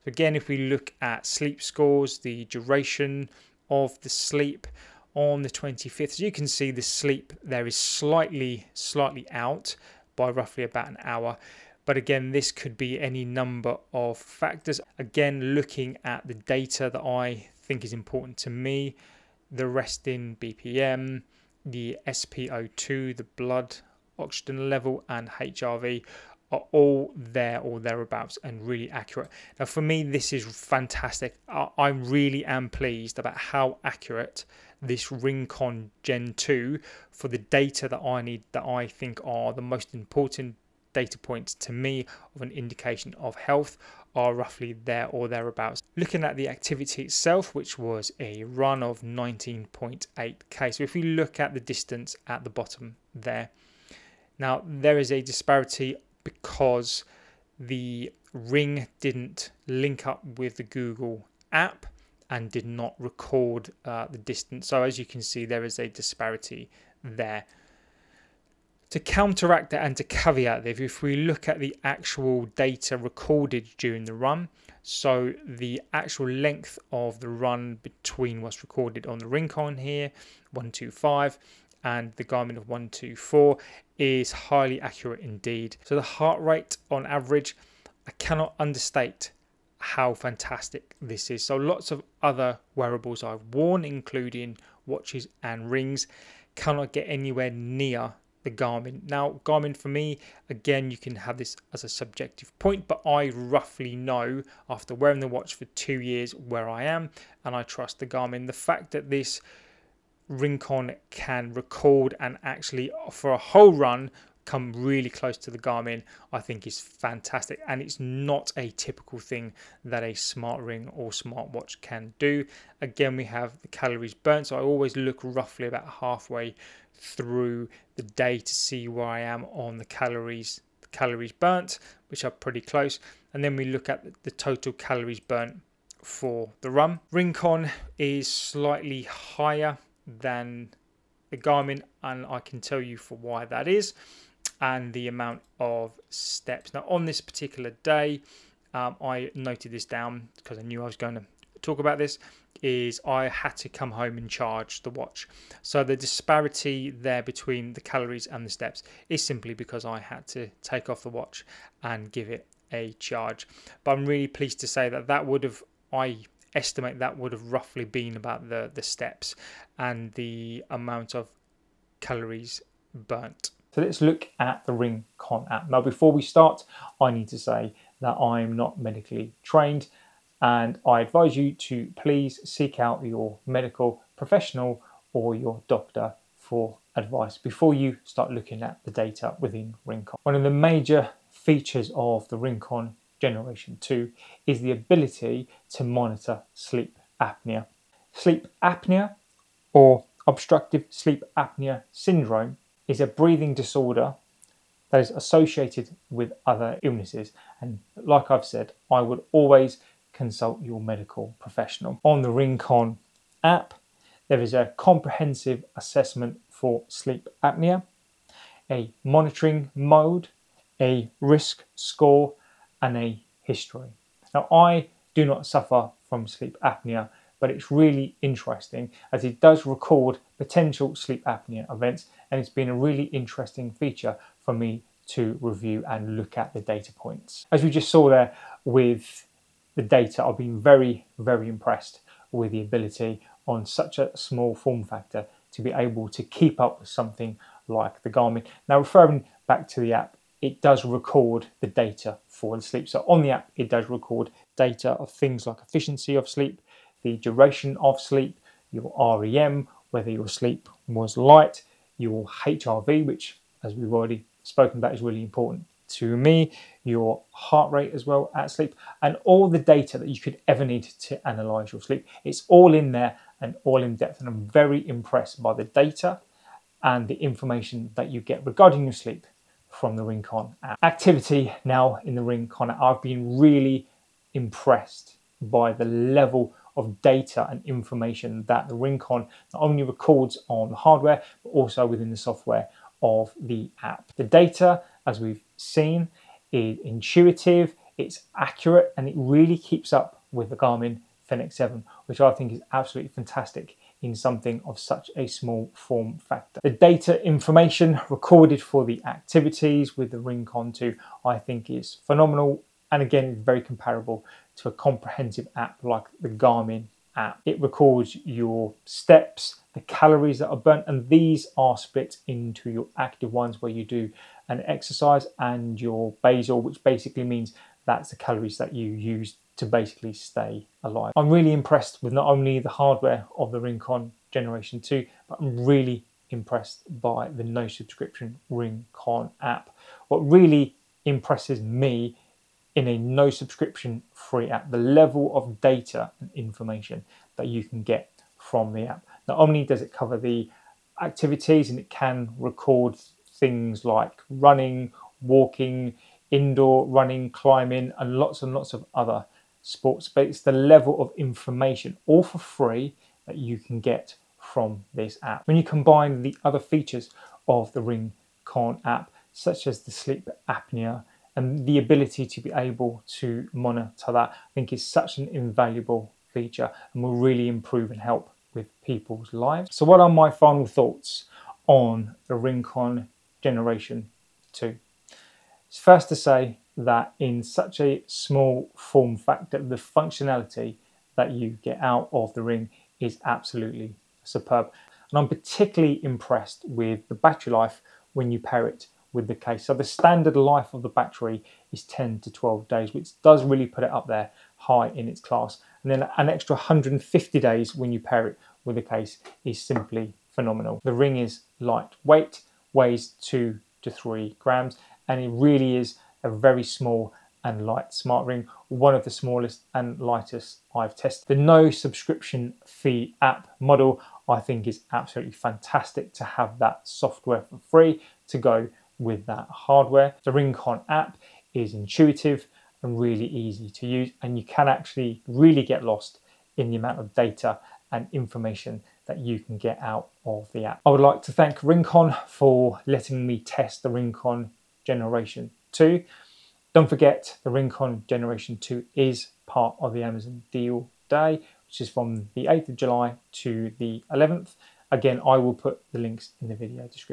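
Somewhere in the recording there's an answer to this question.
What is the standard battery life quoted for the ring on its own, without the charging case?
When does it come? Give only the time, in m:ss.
6:41.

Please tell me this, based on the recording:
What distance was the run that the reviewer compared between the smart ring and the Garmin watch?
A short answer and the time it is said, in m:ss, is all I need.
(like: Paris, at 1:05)
19.8k, at 0:49.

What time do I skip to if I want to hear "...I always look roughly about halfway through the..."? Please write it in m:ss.
2:04.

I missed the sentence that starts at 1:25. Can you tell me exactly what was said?
So the heart rate on average, I cannot understate how fantastic this is.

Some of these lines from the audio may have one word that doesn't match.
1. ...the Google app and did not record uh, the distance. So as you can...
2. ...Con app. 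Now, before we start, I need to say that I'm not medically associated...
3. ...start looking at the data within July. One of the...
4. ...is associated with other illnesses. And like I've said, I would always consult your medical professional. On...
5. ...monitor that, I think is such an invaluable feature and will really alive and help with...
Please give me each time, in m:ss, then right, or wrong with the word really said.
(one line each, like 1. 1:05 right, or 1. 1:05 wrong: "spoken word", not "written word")
1. 1:00 right
2. 2:55 wrong: "trained", not "associated"
3. 3:08 wrong: "RingConn", not "July"
4. 3:24 right
5. 6:13 wrong: "improve", not "alive".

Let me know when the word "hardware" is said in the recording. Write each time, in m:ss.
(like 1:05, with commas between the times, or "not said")
4:50, 5:32, 7:09.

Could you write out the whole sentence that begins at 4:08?
Now, referring back to the app, it does record the data for the sleep.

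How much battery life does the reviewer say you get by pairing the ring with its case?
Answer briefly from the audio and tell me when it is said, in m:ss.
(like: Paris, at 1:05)
150 days, at 6:46.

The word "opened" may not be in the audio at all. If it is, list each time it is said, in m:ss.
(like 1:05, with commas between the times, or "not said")
not said.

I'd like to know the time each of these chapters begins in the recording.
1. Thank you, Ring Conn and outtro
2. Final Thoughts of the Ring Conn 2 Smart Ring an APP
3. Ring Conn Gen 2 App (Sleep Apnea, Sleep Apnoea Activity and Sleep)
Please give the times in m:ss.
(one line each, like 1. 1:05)
1. 7:20
2. 6:19
3. 2:53.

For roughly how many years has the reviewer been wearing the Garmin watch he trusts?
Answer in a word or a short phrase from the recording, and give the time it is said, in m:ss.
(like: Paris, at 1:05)
2 years, at 1:45.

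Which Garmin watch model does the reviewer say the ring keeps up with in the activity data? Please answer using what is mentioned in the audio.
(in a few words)
Garmin Fenix 7.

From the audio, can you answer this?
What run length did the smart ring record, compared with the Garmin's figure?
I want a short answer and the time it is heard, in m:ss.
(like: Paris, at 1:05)
125, at 1:20.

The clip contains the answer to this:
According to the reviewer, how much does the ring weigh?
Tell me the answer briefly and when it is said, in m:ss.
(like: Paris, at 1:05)
2 to 3 grams, at 6:53.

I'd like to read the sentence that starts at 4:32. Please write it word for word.
It's all in there and all in depth.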